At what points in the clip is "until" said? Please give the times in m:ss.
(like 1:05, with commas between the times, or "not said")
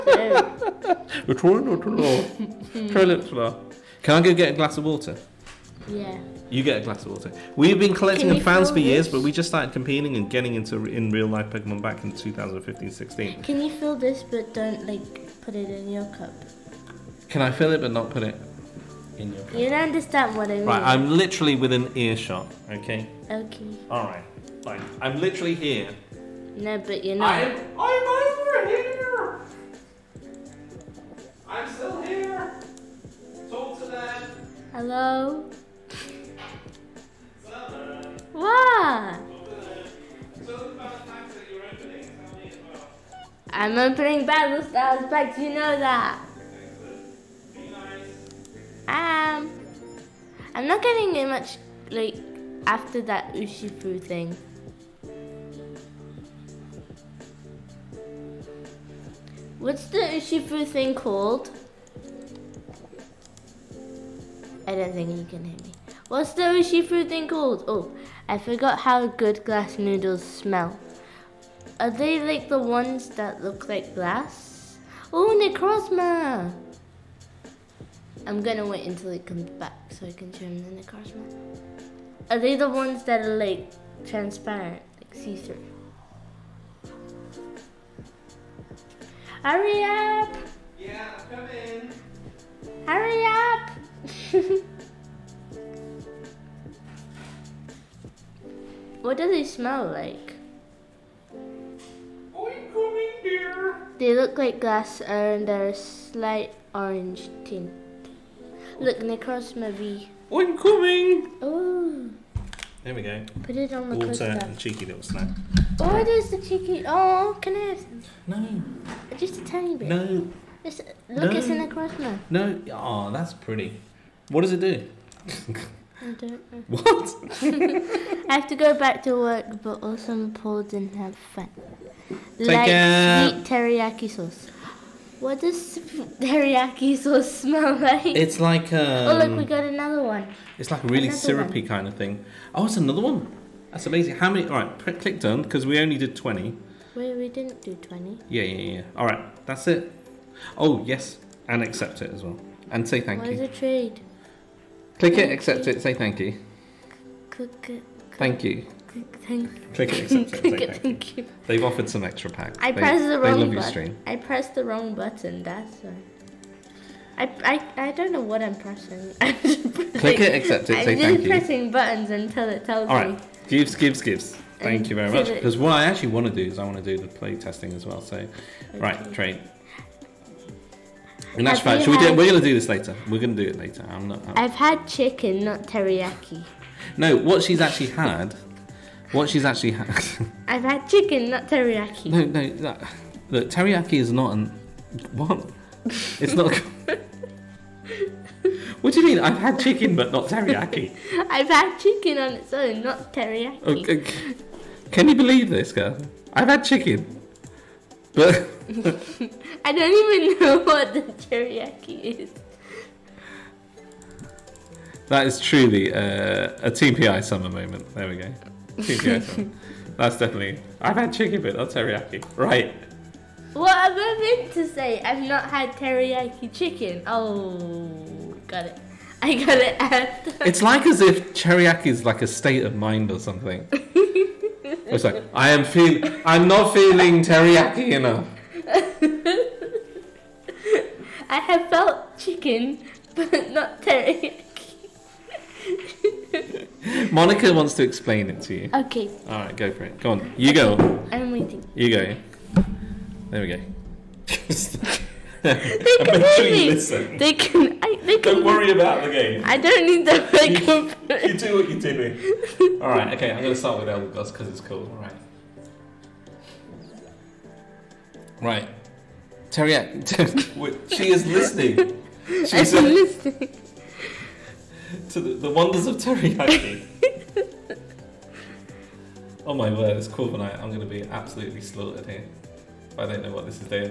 1:18, 2:52.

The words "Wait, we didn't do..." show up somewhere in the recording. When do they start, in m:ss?
2:26.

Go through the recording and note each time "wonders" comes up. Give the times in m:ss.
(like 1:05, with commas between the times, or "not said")
4:35.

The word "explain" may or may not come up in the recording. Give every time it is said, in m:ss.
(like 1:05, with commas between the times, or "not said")
4:07.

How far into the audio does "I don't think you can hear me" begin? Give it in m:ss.
1:04.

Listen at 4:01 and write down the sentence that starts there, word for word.
I have felt chicken, but not teriyaki.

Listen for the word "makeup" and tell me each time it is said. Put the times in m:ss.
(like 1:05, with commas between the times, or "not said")
4:20.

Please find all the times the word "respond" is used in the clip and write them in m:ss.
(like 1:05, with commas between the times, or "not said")
not said.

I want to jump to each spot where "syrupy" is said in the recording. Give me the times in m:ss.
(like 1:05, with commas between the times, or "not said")
2:21.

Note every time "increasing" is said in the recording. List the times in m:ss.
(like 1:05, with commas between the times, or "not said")
not said.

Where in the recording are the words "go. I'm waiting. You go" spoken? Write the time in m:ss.
4:10.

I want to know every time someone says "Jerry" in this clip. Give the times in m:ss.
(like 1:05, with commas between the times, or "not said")
not said.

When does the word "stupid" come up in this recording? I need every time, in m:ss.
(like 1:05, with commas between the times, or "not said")
not said.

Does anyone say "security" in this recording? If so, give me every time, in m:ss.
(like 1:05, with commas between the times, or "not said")
not said.